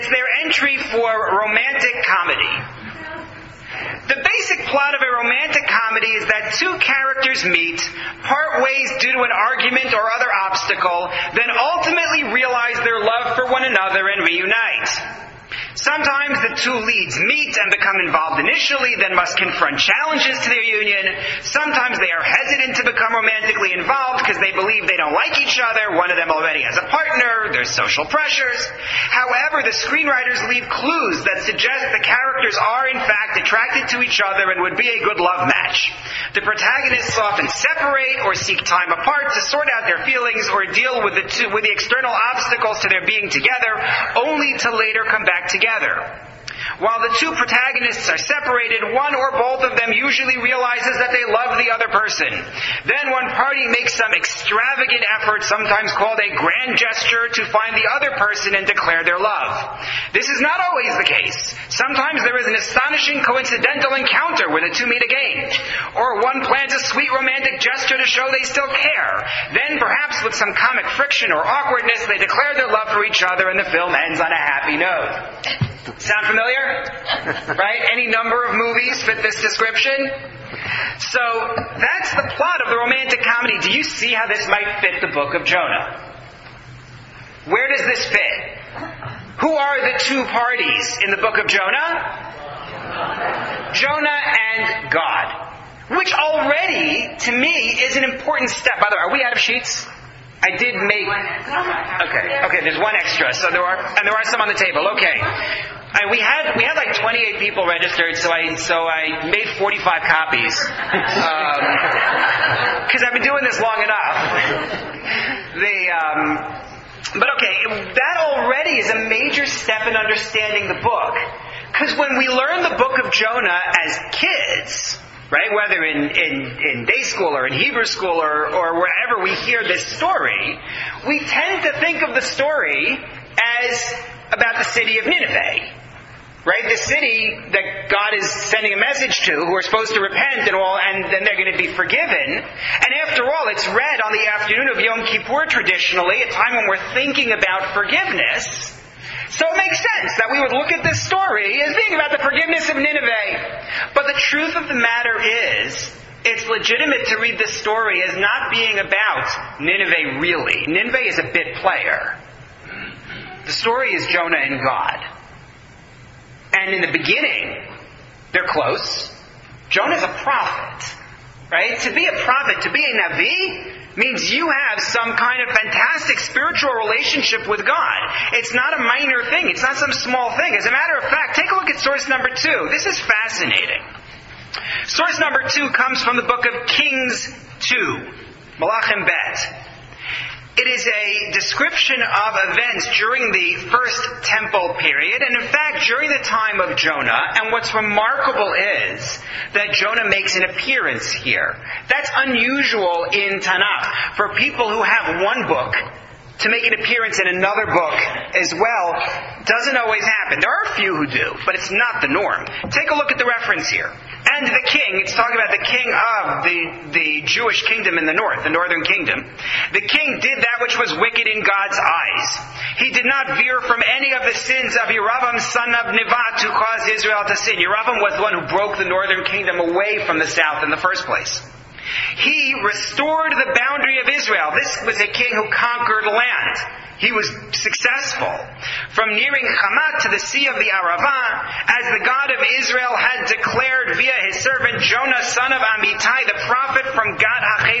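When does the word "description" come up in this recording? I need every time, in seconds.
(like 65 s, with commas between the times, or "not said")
79 s, 191 s.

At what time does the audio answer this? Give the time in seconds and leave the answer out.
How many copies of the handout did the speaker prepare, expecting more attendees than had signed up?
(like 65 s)
109 s.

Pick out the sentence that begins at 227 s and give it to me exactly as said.
Yeravam was the one who broke the northern kingdom away from the south in the first place.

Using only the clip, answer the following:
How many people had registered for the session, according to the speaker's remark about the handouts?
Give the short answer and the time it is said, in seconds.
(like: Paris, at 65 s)
28, at 106 s.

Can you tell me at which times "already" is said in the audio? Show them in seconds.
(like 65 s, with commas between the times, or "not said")
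26 s, 96 s, 118 s.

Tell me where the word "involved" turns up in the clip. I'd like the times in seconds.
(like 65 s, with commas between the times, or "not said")
18 s, 23 s.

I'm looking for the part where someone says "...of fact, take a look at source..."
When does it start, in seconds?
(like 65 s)
180 s.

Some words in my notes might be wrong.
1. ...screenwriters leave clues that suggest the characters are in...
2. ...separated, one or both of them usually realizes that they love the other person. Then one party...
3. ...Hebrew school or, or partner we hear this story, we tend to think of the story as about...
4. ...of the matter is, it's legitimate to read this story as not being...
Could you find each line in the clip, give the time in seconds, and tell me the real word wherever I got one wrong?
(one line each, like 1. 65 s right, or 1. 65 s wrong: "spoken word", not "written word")
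1. 29 s right
2. 48 s right
3. 127 s wrong: "wherever", not "partner"
4. 154 s right.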